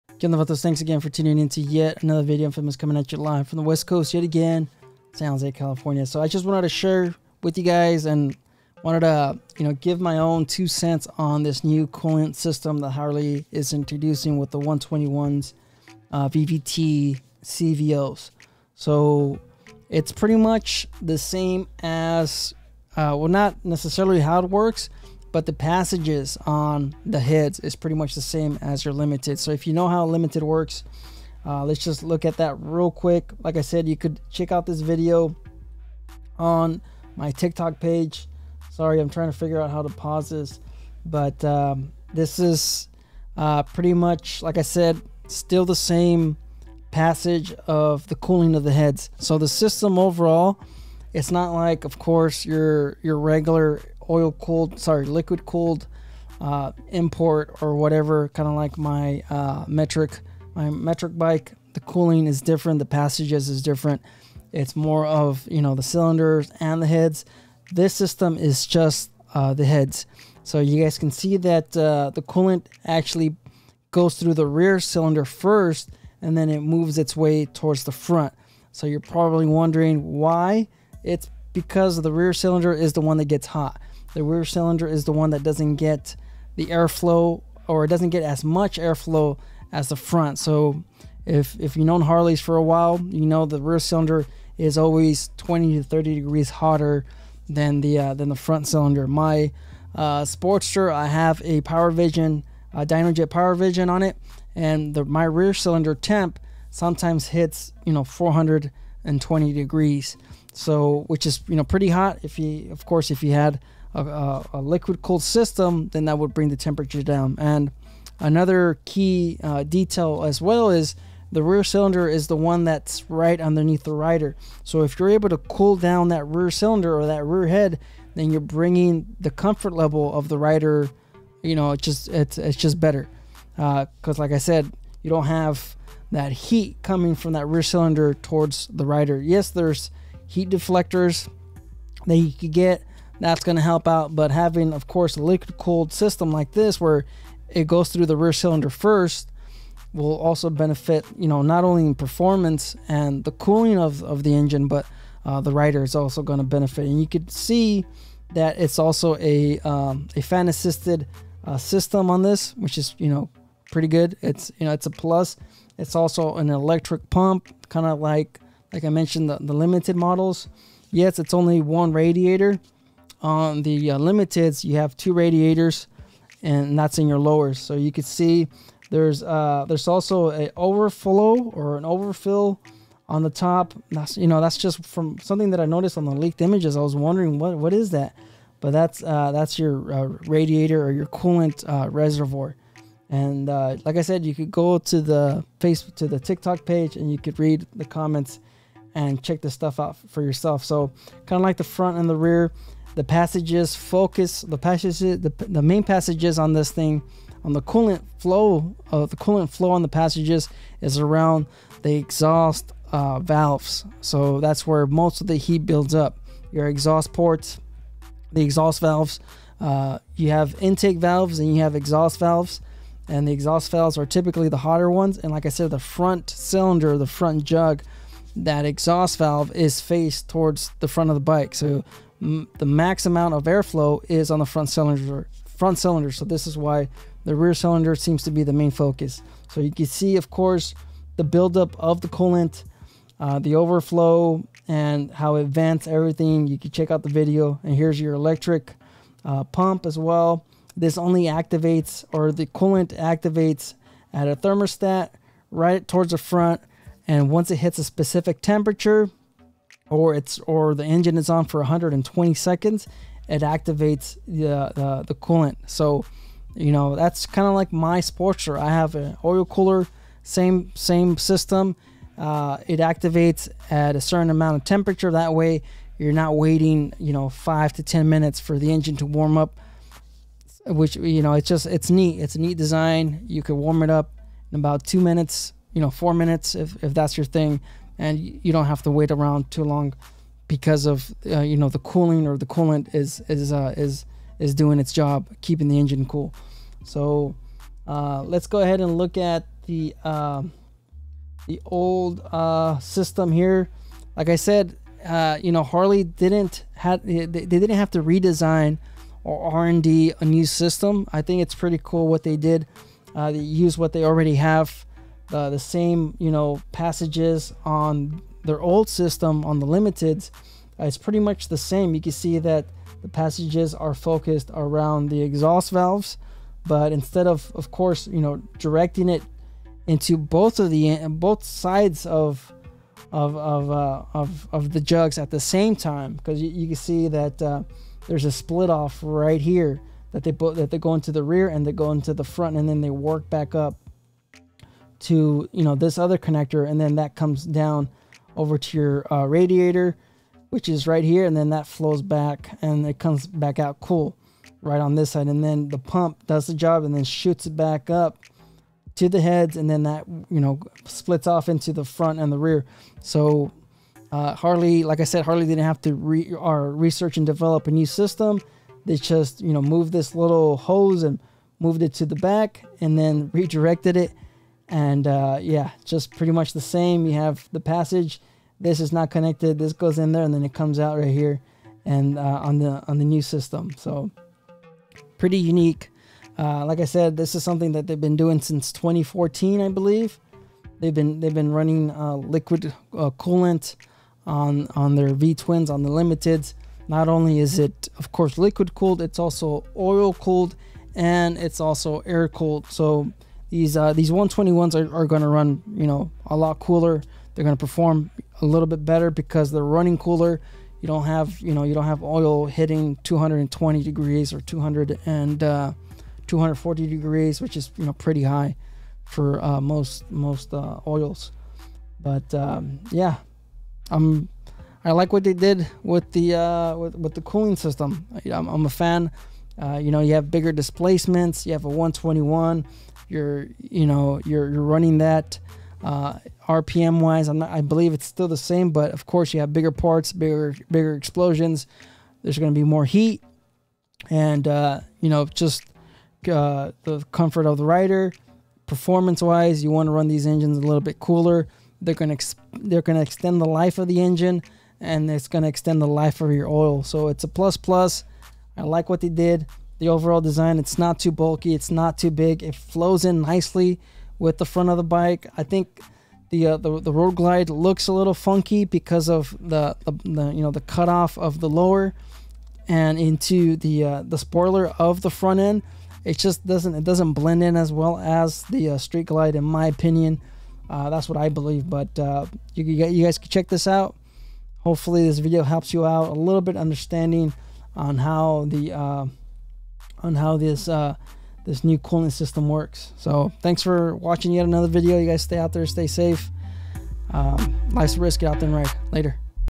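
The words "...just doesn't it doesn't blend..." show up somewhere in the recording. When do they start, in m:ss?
7:56.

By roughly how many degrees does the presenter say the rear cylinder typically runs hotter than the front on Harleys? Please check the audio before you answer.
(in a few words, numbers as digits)
20 to 30 degrees.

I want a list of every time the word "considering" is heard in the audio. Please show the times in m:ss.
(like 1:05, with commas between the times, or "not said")
not said.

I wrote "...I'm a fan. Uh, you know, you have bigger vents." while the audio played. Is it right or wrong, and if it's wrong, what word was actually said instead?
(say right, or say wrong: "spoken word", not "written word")
wrong: "displacements", not "vents".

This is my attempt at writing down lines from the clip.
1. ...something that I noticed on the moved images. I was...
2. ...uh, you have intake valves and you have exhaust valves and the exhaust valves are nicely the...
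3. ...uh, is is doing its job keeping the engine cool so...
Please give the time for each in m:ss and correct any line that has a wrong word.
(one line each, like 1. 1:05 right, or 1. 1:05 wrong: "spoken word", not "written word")
1. 3:05 wrong: "leaked", not "moved"
2. 3:39 wrong: "typically", not "nicely"
3. 4:53 right.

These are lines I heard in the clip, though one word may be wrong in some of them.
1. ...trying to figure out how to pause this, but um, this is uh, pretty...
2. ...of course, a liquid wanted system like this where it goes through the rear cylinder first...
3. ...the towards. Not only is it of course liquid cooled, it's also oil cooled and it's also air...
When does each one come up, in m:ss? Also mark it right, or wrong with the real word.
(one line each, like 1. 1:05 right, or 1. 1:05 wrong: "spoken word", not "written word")
1. 0:39 right
2. 2:24 wrong: "cooled", not "wanted"
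3. 6:35 wrong: "limiteds", not "towards".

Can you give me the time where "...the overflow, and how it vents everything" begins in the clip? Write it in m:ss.
4:03.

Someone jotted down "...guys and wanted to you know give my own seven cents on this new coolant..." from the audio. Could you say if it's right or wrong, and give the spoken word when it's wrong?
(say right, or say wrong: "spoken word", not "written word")
wrong: "two", not "seven".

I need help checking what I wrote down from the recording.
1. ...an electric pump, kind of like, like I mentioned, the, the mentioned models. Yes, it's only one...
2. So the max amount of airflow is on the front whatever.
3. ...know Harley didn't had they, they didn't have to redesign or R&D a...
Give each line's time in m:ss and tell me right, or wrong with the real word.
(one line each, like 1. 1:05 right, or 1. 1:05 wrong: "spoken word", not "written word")
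1. 2:46 wrong: "limited", not "mentioned"
2. 3:51 wrong: "cylinder", not "whatever"
3. 5:05 right.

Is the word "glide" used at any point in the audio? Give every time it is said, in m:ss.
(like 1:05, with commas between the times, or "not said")
7:47, 7:59.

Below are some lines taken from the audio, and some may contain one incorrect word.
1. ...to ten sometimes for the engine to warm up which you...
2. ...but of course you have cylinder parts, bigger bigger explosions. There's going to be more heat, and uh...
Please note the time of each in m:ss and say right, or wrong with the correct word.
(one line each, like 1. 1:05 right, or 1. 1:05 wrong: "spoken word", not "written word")
1. 4:37 wrong: "minutes", not "sometimes"
2. 7:18 wrong: "bigger", not "cylinder".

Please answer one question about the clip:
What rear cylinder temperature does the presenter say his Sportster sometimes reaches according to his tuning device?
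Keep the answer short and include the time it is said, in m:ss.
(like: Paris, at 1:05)
420 degrees, at 1:48.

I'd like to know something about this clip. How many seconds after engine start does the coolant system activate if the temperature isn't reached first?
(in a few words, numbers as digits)
120.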